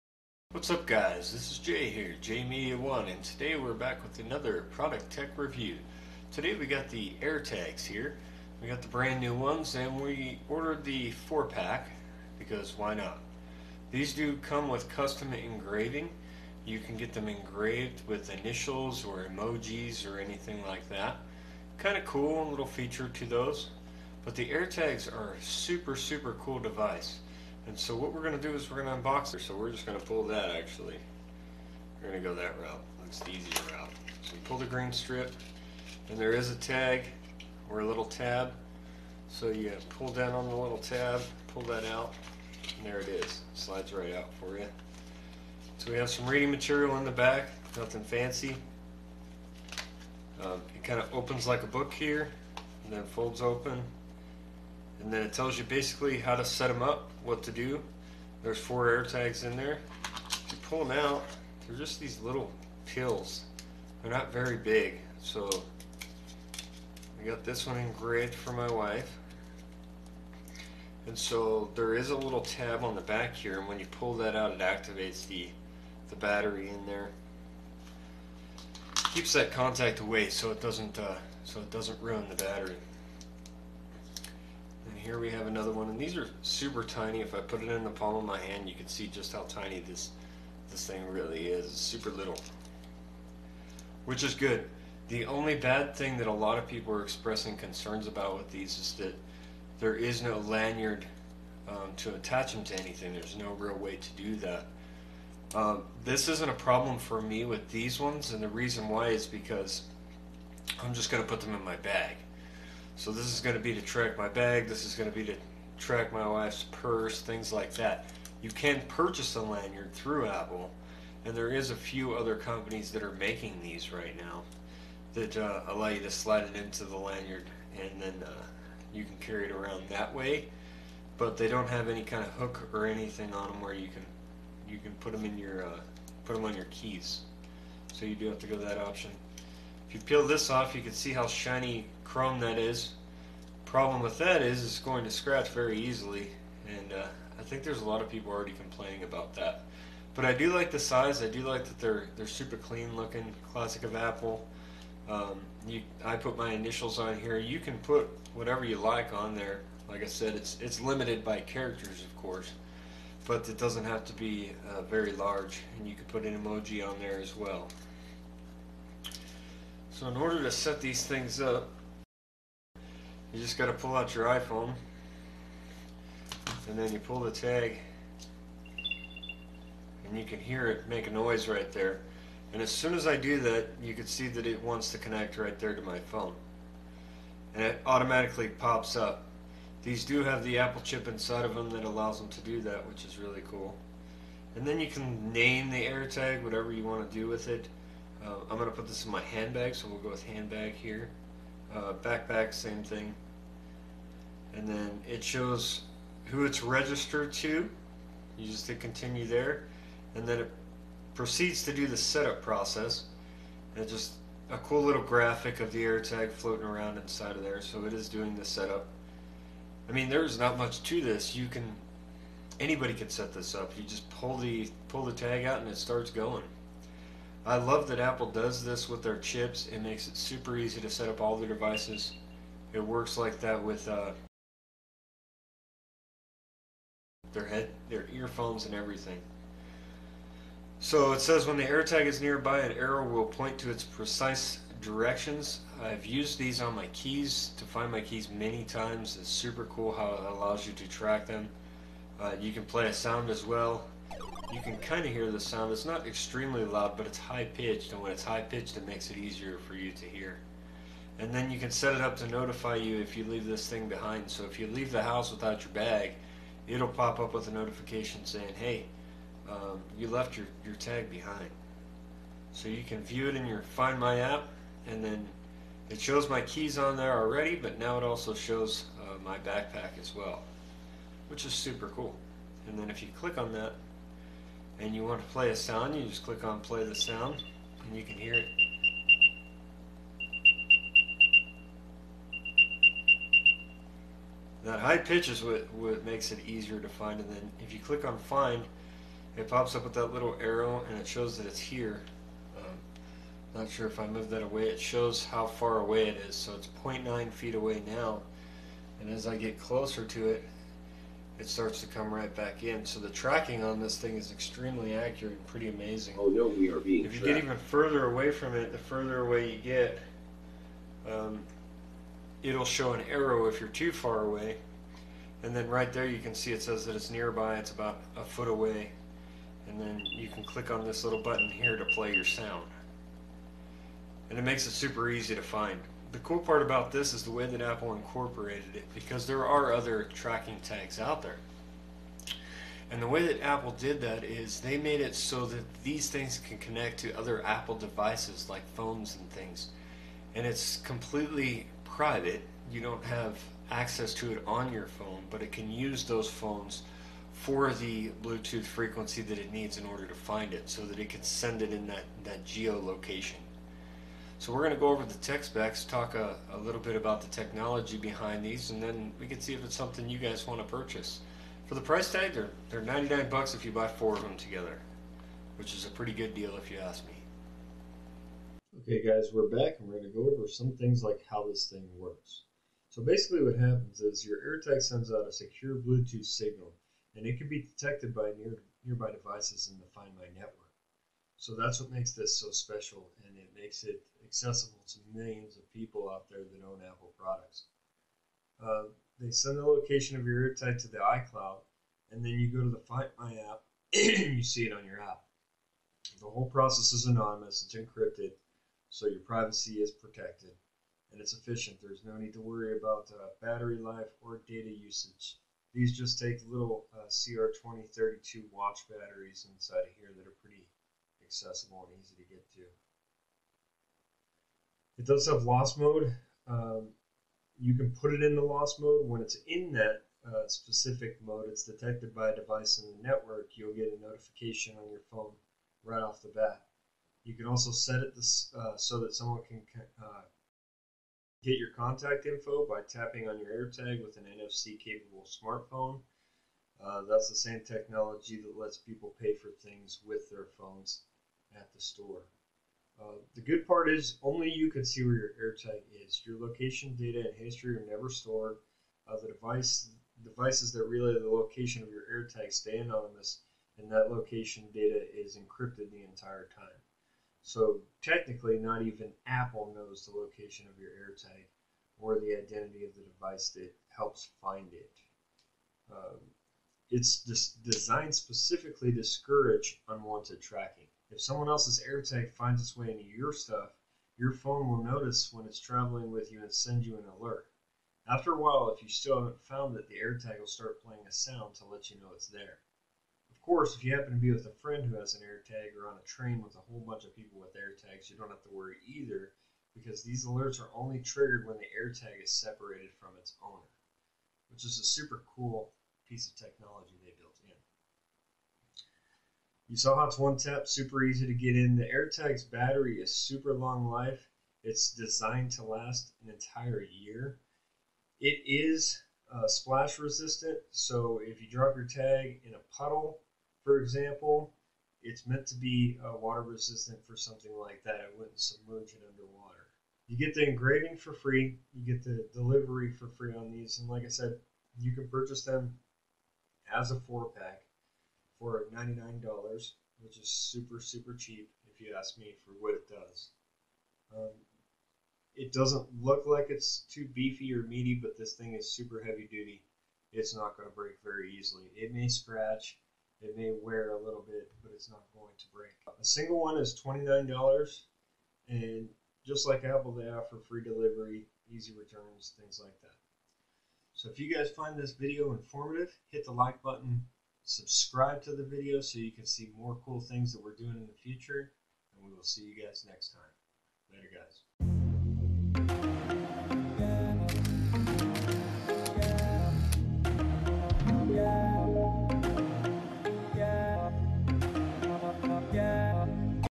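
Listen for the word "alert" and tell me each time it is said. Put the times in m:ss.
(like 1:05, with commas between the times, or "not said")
8:07, 8:20.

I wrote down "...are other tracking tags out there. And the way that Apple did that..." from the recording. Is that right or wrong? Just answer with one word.
right.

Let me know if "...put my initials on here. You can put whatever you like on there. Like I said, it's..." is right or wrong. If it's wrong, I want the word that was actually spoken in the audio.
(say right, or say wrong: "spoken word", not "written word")
right.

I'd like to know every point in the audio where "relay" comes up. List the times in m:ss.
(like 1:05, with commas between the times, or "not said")
7:40.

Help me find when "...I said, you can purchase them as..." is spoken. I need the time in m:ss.
8:54.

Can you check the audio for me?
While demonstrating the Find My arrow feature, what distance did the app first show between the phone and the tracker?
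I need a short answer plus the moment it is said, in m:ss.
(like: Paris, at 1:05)
0.9 feet, at 5:06.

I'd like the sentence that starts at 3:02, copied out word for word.
And as soon as I do that, you can see that it wants to connect right there to my phone.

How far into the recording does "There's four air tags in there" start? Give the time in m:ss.
0:58.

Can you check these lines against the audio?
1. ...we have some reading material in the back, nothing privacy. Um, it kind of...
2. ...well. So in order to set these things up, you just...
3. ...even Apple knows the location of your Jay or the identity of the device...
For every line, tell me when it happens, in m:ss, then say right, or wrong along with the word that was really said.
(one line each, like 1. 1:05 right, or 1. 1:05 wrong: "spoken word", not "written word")
1. 0:45 wrong: "fancy", not "privacy"
2. 2:47 right
3. 7:48 wrong: "AirTag", not "Jay".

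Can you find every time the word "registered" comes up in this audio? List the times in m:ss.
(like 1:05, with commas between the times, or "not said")
3:26.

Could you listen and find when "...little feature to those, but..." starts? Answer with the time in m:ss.
0:22.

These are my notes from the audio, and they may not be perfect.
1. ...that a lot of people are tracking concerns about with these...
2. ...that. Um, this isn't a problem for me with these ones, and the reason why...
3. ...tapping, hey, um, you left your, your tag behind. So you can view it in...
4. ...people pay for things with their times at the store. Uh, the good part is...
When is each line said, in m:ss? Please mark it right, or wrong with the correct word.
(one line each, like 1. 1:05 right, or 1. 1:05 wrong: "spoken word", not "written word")
1. 1:36 wrong: "expressing", not "tracking"
2. 1:44 right
3. 4:28 wrong: "saying", not "tapping"
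4. 7:28 wrong: "phones", not "times".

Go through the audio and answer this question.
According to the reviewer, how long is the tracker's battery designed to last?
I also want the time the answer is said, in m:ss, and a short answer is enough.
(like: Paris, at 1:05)
an entire year, at 8:36.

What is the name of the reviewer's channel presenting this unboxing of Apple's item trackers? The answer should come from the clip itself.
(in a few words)
Jay Media One.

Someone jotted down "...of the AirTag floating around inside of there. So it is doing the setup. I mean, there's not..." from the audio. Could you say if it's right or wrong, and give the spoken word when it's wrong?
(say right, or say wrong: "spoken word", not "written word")
right.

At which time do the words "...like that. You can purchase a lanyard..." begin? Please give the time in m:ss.
1:57.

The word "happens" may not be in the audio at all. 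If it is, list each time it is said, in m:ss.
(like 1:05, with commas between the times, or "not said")
6:23, 8:13.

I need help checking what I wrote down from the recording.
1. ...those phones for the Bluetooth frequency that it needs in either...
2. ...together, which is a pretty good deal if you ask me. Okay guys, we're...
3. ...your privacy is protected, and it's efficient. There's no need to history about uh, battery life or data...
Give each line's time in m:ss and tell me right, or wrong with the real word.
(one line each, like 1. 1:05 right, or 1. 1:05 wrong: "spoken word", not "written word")
1. 5:56 wrong: "order", not "either"
2. 6:14 right
3. 6:49 wrong: "worry", not "history".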